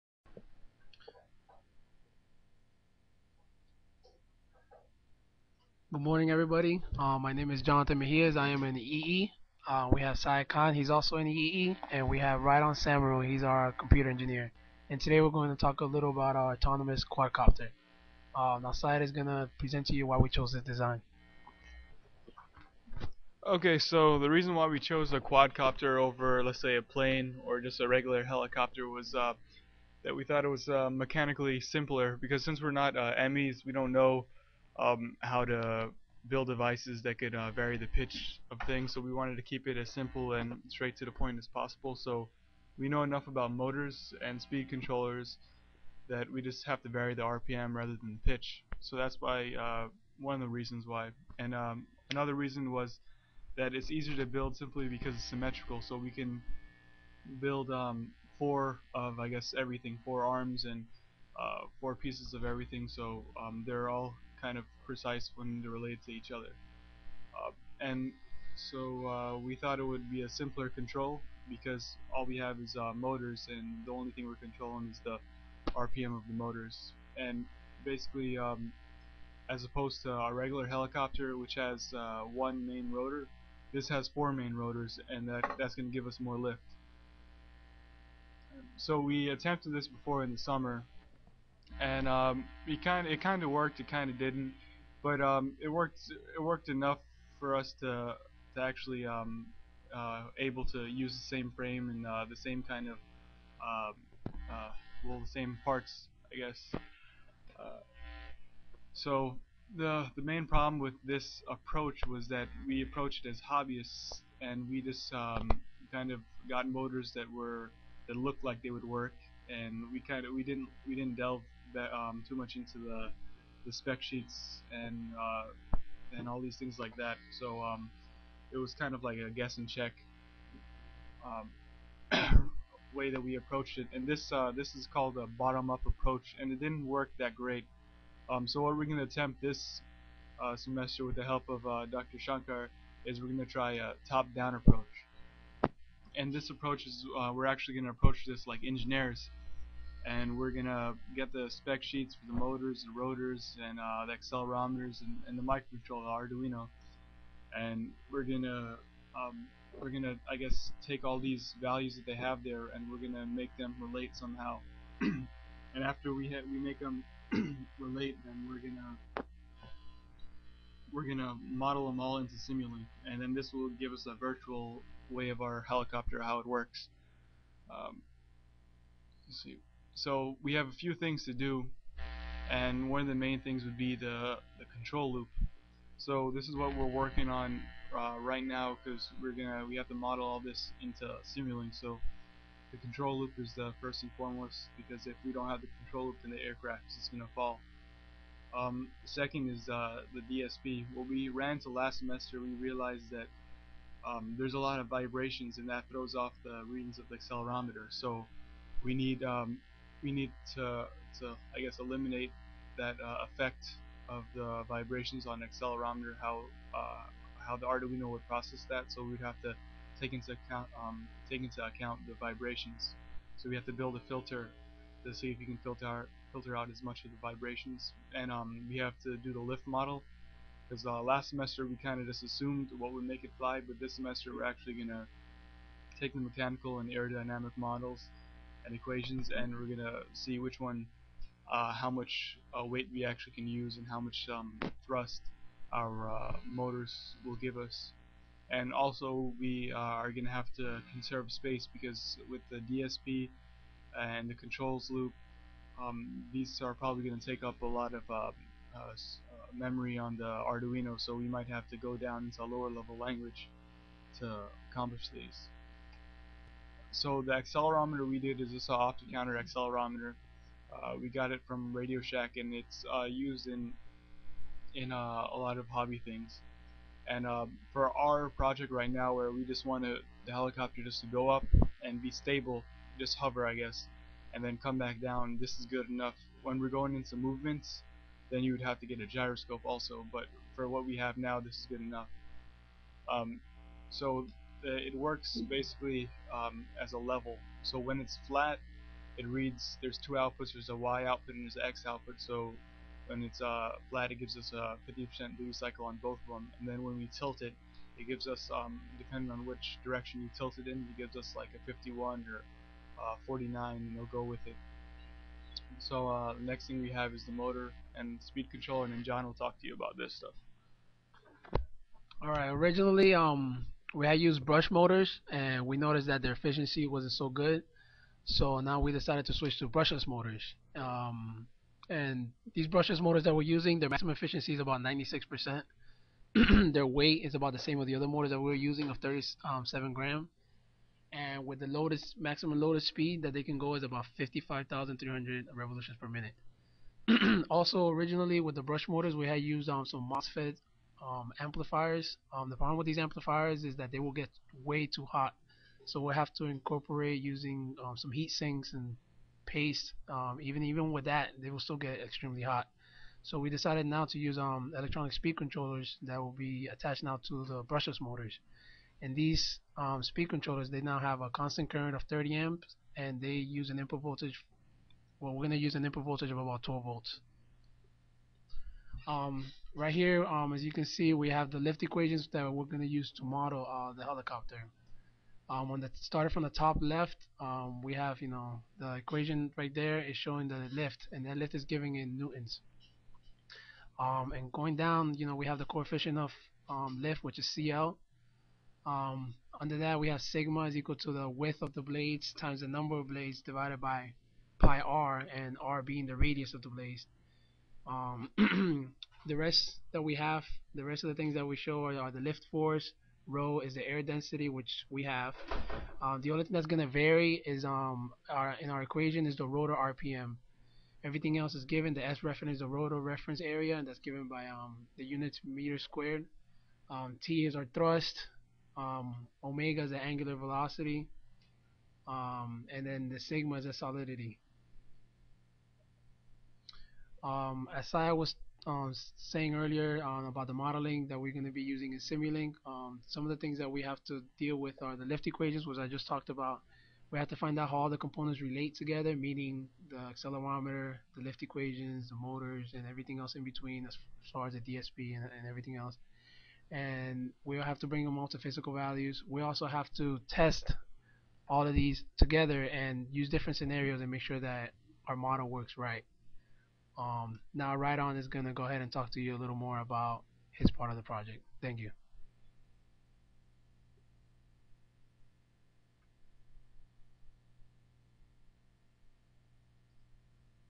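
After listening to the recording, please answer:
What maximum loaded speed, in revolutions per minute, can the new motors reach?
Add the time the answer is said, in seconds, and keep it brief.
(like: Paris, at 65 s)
55,300, at 344 s.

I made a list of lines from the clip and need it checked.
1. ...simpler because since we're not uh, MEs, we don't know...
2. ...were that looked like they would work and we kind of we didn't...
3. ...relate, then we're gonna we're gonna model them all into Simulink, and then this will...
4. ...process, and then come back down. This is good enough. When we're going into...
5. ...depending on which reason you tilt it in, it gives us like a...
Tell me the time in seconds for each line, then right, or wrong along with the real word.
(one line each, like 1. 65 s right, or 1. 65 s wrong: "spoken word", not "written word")
1. 31 s right
2. 117 s right
3. 167 s right
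4. 283 s wrong: "guess", not "process"
5. 308 s wrong: "direction", not "reason".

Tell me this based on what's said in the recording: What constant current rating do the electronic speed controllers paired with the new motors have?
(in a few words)
30 amps.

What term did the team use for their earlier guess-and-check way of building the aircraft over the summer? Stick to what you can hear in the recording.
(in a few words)
bottom up approach.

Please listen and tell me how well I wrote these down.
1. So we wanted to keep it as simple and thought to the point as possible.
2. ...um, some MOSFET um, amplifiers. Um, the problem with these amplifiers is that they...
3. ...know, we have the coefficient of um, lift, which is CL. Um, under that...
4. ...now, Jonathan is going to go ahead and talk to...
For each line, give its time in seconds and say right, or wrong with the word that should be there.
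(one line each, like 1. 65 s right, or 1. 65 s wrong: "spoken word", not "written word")
1. 38 s wrong: "straight", not "thought"
2. 349 s right
3. 395 s right
4. 467 s wrong: "Rydon", not "Jonathan".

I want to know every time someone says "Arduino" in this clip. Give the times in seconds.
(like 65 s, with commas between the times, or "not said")
156 s, 217 s, 260 s.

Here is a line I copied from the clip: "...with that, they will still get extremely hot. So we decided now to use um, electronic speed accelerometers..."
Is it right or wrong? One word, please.
wrong.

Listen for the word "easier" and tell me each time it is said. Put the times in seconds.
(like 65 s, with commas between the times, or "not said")
53 s.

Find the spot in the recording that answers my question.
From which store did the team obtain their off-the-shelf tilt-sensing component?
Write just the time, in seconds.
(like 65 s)
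271 s.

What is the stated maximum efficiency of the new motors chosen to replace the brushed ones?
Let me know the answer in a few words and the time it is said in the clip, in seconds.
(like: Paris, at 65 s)
96%, at 334 s.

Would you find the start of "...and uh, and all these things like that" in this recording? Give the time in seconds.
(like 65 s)
124 s.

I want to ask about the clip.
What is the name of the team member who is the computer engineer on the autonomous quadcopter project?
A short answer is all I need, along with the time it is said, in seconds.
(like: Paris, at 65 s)
Rydon Samaru, at 12 s.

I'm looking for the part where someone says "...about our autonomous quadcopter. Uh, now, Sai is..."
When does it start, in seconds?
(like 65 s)
16 s.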